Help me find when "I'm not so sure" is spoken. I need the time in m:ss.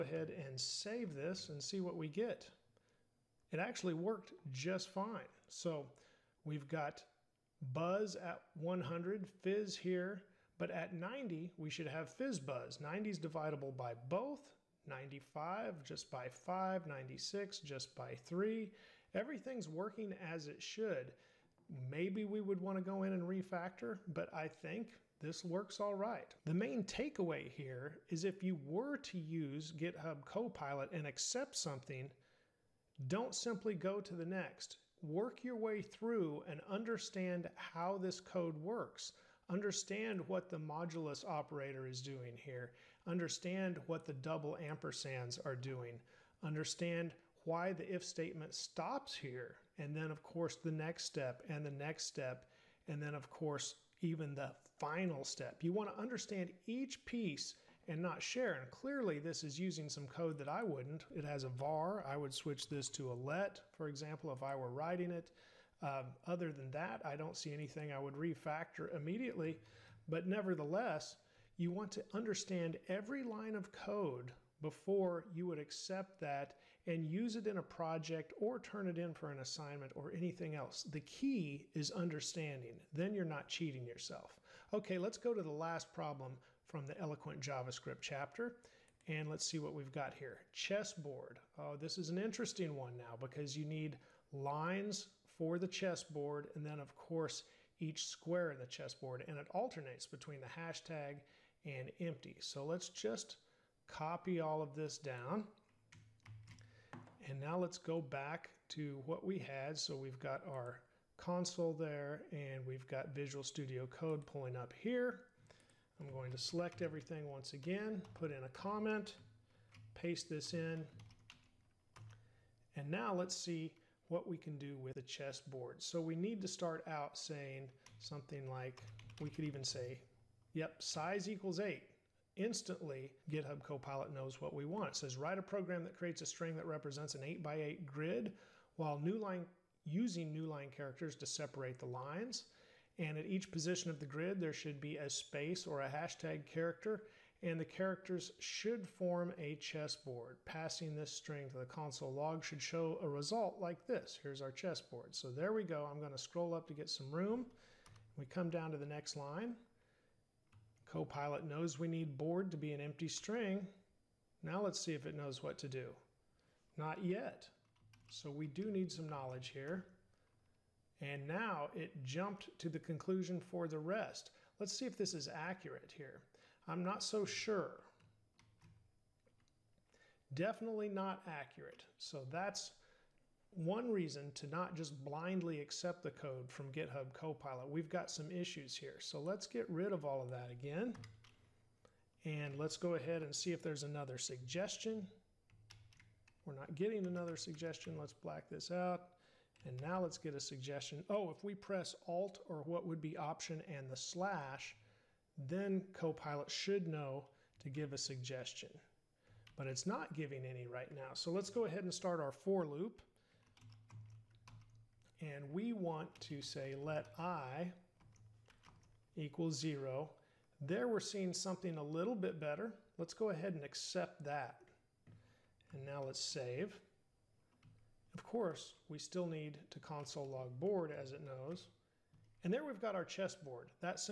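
2:56.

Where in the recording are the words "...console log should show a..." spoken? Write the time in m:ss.
2:31.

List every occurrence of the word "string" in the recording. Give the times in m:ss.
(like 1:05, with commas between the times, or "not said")
2:16, 2:31, 2:43.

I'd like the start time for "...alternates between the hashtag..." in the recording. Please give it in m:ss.
1:39.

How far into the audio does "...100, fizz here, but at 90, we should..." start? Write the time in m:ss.
0:08.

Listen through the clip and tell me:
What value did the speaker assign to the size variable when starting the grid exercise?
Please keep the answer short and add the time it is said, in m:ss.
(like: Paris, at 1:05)
8, at 2:11.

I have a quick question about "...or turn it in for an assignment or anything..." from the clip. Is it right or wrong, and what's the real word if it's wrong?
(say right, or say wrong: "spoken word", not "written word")
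right.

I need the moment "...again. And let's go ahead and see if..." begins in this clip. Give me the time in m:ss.
3:10.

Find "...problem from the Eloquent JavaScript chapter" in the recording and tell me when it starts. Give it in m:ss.
1:25.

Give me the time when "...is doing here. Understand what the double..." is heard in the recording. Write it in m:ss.
0:41.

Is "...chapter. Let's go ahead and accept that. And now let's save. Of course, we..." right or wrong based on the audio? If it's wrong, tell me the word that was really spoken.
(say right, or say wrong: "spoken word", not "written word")
wrong: "better", not "chapter".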